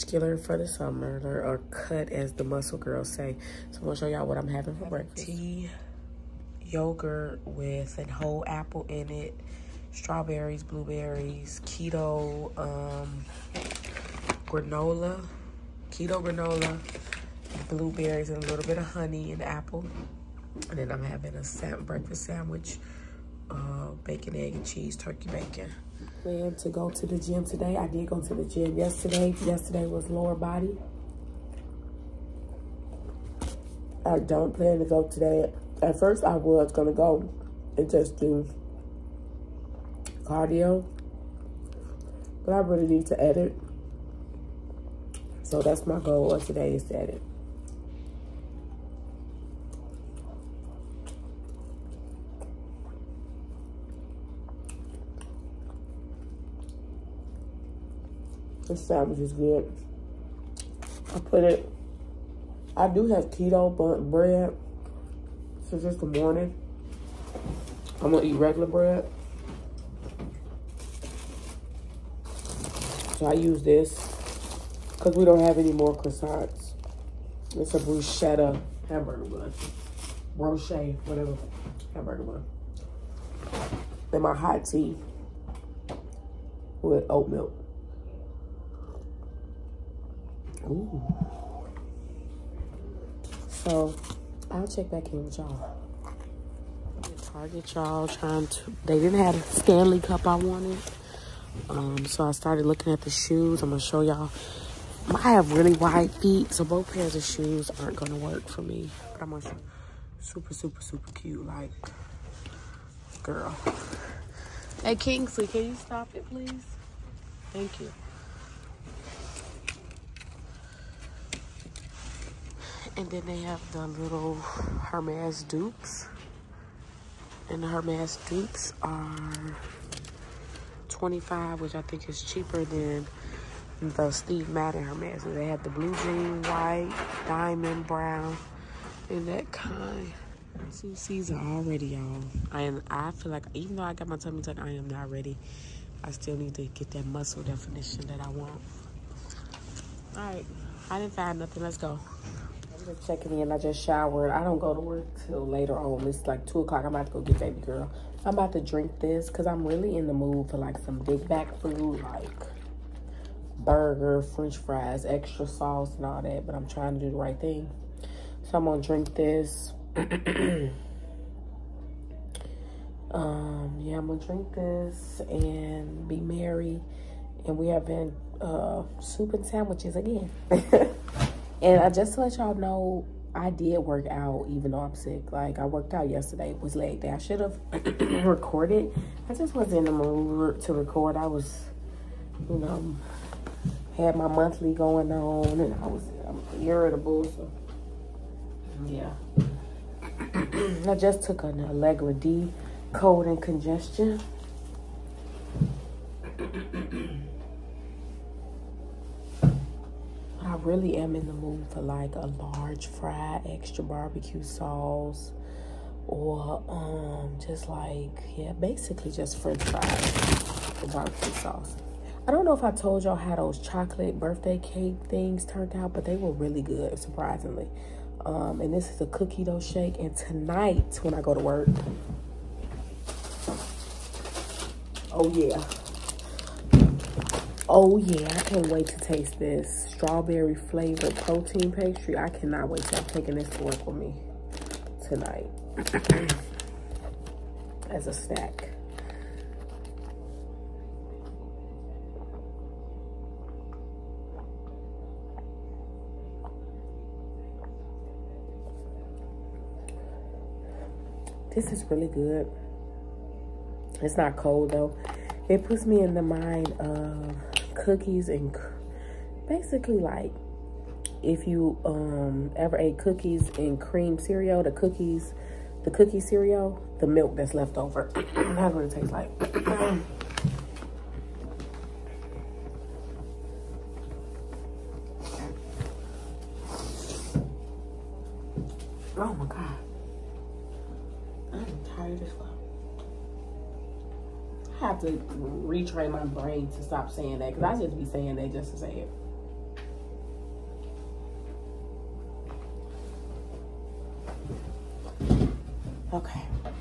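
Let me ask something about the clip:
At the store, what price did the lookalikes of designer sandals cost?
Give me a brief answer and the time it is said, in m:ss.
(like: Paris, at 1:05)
25, at 2:10.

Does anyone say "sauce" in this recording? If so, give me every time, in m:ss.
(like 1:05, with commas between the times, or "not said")
2:45, 3:34, 3:41.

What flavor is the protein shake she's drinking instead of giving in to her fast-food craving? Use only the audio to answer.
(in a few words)
Cookie dough.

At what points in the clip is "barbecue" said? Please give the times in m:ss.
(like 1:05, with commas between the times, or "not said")
3:33, 3:40.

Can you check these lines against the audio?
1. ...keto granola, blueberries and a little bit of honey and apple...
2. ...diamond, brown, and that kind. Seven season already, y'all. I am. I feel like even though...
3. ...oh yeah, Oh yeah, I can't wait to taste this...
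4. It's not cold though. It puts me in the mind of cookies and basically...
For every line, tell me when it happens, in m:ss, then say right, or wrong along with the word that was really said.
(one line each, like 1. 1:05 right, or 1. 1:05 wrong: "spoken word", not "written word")
1. 0:15 right
2. 2:17 wrong: "Two", not "Seven"
3. 3:55 right
4. 4:24 right.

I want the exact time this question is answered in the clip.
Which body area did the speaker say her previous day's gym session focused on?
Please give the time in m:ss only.
0:30.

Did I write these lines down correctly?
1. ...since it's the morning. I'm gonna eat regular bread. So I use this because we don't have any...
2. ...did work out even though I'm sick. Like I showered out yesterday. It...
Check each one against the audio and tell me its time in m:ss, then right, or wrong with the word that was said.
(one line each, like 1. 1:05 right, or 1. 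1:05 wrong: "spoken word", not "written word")
1. 1:05 right
2. 3:03 wrong: "worked", not "showered".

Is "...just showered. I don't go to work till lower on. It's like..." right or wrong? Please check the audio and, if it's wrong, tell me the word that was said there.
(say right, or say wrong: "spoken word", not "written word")
wrong: "later", not "lower".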